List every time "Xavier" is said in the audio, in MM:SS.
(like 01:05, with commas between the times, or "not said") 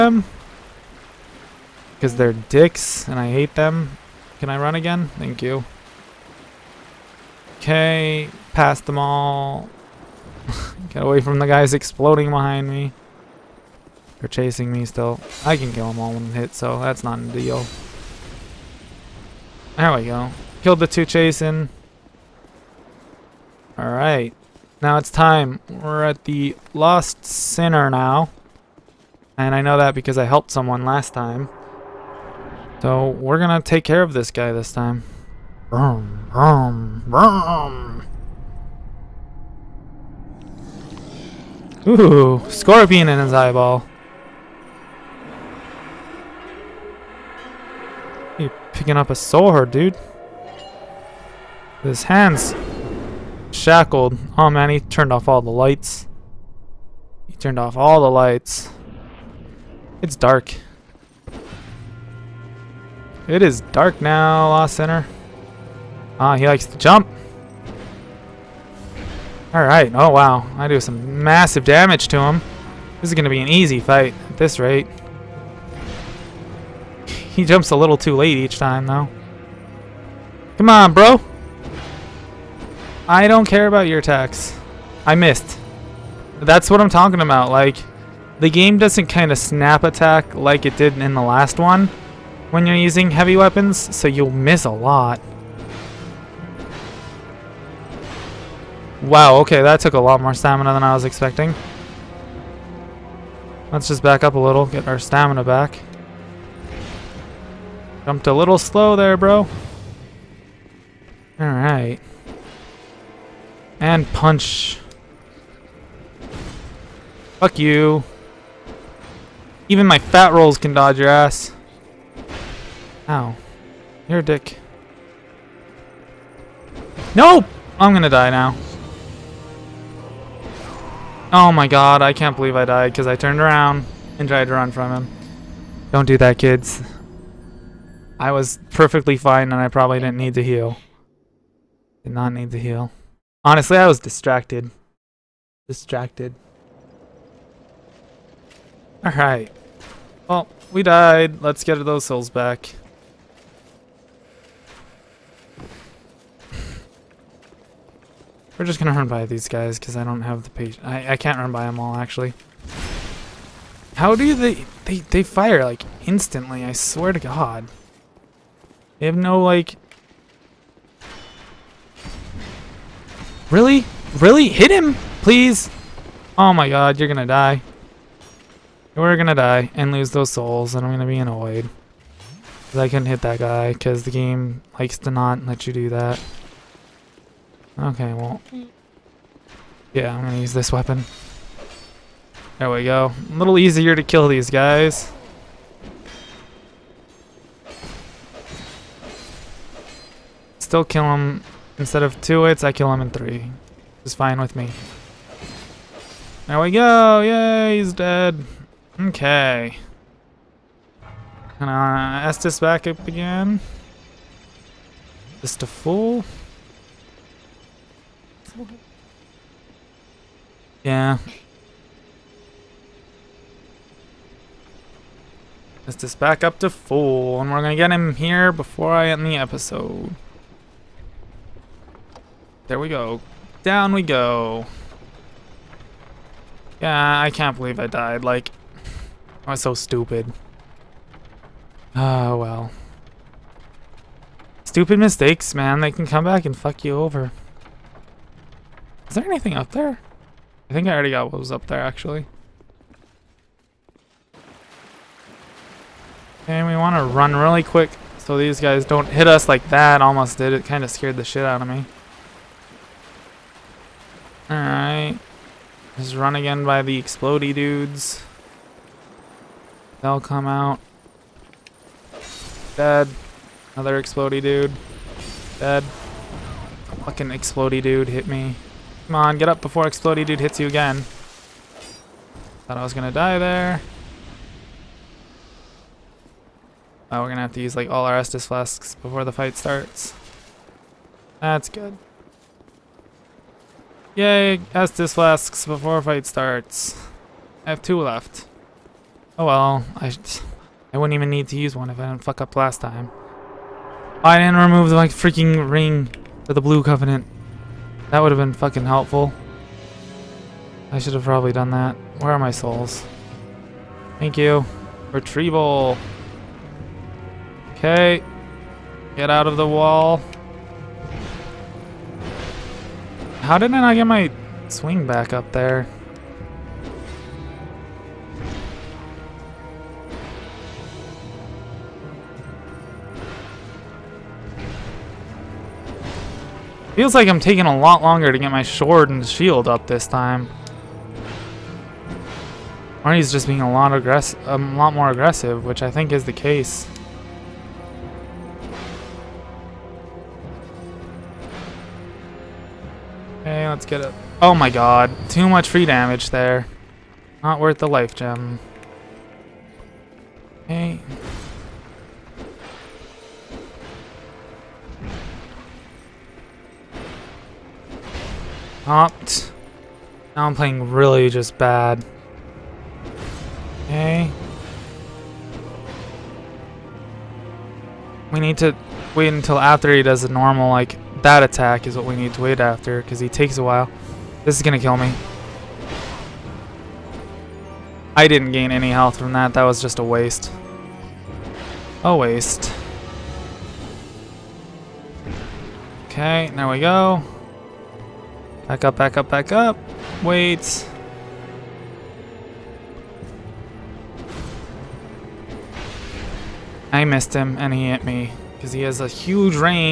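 not said.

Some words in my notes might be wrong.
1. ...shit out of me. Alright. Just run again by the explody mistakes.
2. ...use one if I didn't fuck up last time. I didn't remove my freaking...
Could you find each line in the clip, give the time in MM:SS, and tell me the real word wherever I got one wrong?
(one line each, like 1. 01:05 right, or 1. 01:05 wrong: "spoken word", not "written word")
1. 04:21 wrong: "dudes", not "mistakes"
2. 05:01 right.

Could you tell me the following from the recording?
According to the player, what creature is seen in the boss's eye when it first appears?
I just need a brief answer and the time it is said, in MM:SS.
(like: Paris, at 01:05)
scorpion, at 00:42.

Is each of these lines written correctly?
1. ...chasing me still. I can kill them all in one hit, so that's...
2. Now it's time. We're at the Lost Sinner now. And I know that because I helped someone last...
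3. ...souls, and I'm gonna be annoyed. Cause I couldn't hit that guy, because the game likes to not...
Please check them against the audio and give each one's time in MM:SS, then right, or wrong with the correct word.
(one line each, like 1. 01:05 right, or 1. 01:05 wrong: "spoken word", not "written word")
1. 00:14 right
2. 00:24 right
3. 03:00 right.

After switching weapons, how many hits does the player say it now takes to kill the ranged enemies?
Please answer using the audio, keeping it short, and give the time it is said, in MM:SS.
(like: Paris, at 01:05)
3, at 03:23.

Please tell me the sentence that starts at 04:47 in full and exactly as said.
Oh, we're gonna have to use like all our Estus flasks before the fight starts.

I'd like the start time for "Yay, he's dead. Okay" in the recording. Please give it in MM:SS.
03:27.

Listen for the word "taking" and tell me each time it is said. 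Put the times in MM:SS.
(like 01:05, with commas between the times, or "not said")
05:37.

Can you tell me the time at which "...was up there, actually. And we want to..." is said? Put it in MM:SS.
04:11.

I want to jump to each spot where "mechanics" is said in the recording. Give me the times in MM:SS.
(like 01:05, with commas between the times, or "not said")
not said.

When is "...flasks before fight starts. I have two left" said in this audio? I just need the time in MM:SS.
04:55.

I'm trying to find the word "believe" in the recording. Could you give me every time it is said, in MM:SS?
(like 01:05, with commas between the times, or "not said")
02:12, 03:57.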